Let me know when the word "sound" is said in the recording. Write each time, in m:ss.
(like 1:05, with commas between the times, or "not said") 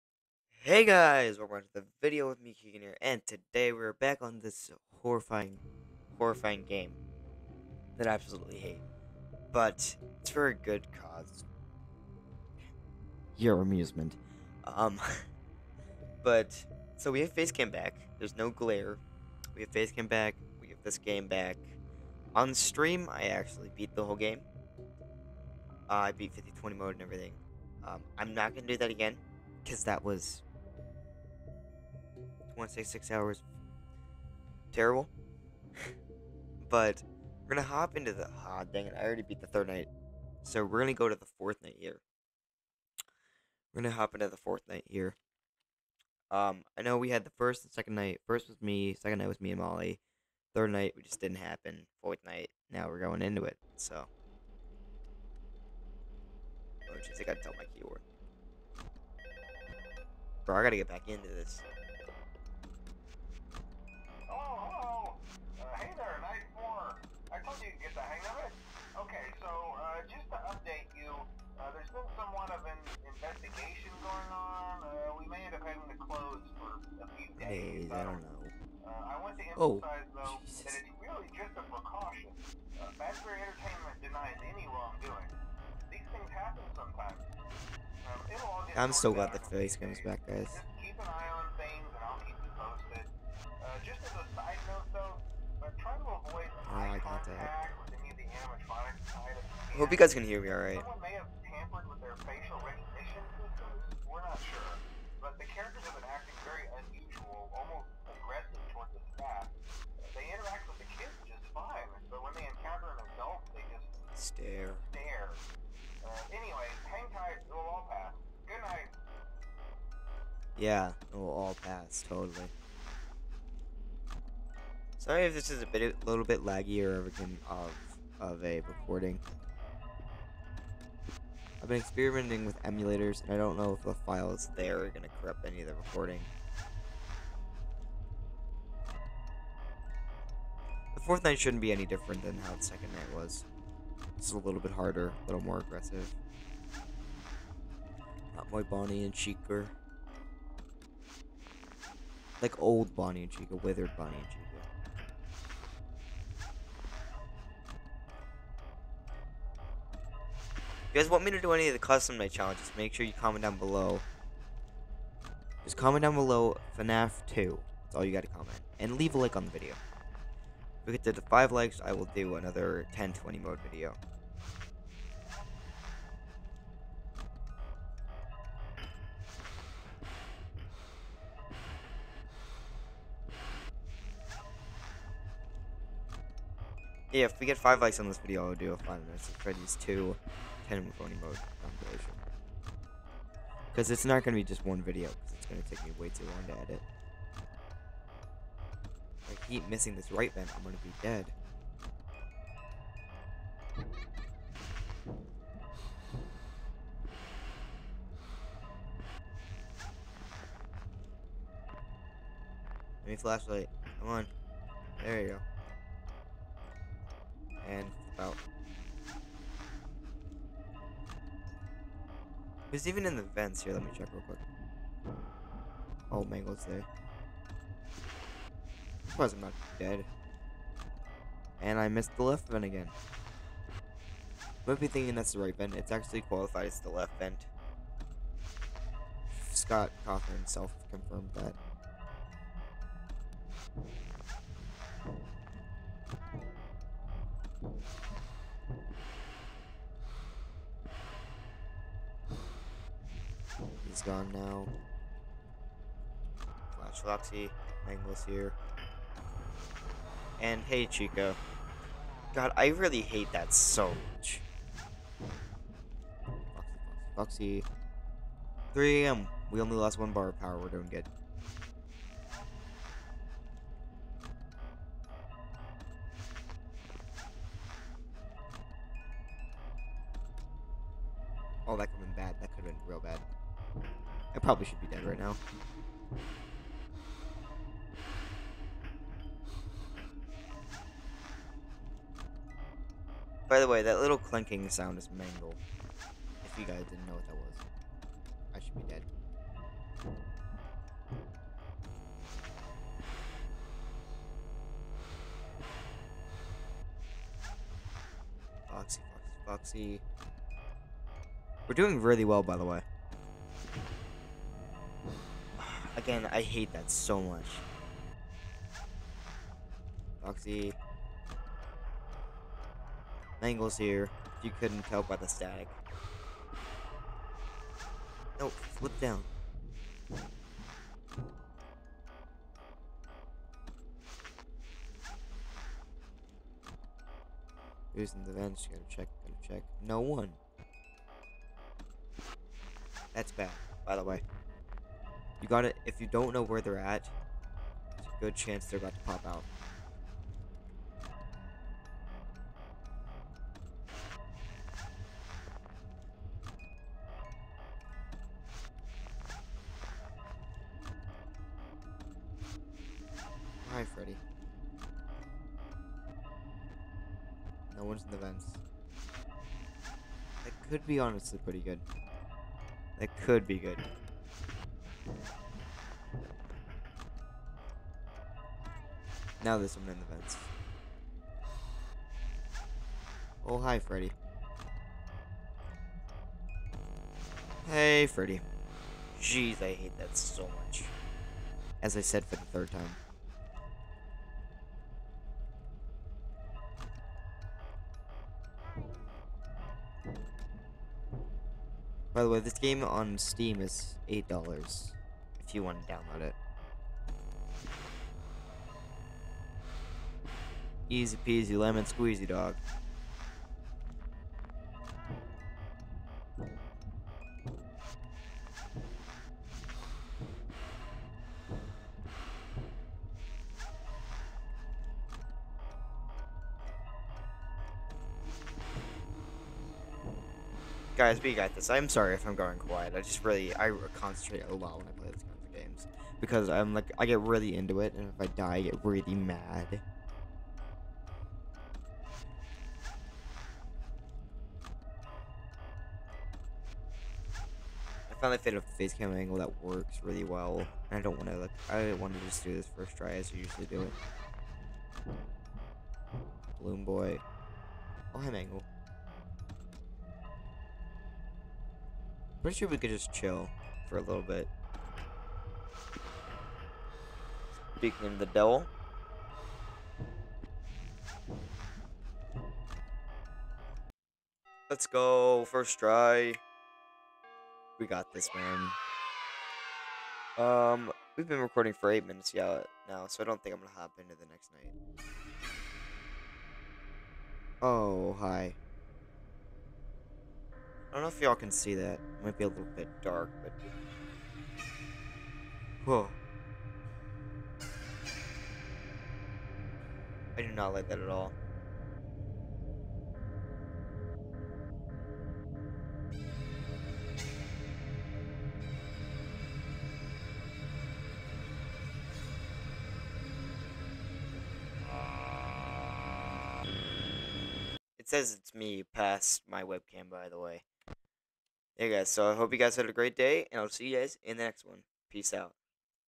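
4:54.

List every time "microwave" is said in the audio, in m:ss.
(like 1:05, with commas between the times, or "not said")
not said.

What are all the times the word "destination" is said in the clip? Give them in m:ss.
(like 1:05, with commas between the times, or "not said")
not said.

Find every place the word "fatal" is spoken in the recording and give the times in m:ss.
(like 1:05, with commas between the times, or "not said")
not said.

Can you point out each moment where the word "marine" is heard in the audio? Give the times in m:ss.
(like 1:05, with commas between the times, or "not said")
not said.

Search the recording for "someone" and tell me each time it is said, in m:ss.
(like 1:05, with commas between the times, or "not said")
1:40, 6:19.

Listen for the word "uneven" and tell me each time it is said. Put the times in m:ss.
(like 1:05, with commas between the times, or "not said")
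not said.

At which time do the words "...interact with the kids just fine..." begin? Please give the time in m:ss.
1:50.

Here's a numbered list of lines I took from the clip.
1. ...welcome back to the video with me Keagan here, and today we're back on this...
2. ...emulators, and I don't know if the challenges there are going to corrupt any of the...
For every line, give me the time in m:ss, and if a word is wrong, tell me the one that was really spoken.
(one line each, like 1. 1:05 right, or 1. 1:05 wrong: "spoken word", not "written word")
1. 0:01 right
2. 2:12 wrong: "files", not "challenges".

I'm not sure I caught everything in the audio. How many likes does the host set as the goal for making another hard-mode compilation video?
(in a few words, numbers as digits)
5.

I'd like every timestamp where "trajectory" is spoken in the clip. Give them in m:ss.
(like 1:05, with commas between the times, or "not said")
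not said.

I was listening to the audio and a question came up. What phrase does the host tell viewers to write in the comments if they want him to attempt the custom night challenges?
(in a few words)
FNAF 2.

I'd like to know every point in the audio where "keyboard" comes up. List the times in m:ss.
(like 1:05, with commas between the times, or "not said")
0:57.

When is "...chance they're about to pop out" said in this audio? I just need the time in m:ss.
5:48.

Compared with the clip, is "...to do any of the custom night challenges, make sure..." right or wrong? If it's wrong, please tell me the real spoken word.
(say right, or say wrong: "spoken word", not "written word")
right.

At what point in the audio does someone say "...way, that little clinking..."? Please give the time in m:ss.
4:53.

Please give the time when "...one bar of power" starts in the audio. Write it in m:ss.
4:29.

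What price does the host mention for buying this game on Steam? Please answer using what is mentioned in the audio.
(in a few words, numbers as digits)
$8.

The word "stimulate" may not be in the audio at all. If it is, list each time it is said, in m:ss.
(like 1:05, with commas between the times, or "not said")
not said.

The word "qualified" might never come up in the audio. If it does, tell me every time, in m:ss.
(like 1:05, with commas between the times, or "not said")
3:56.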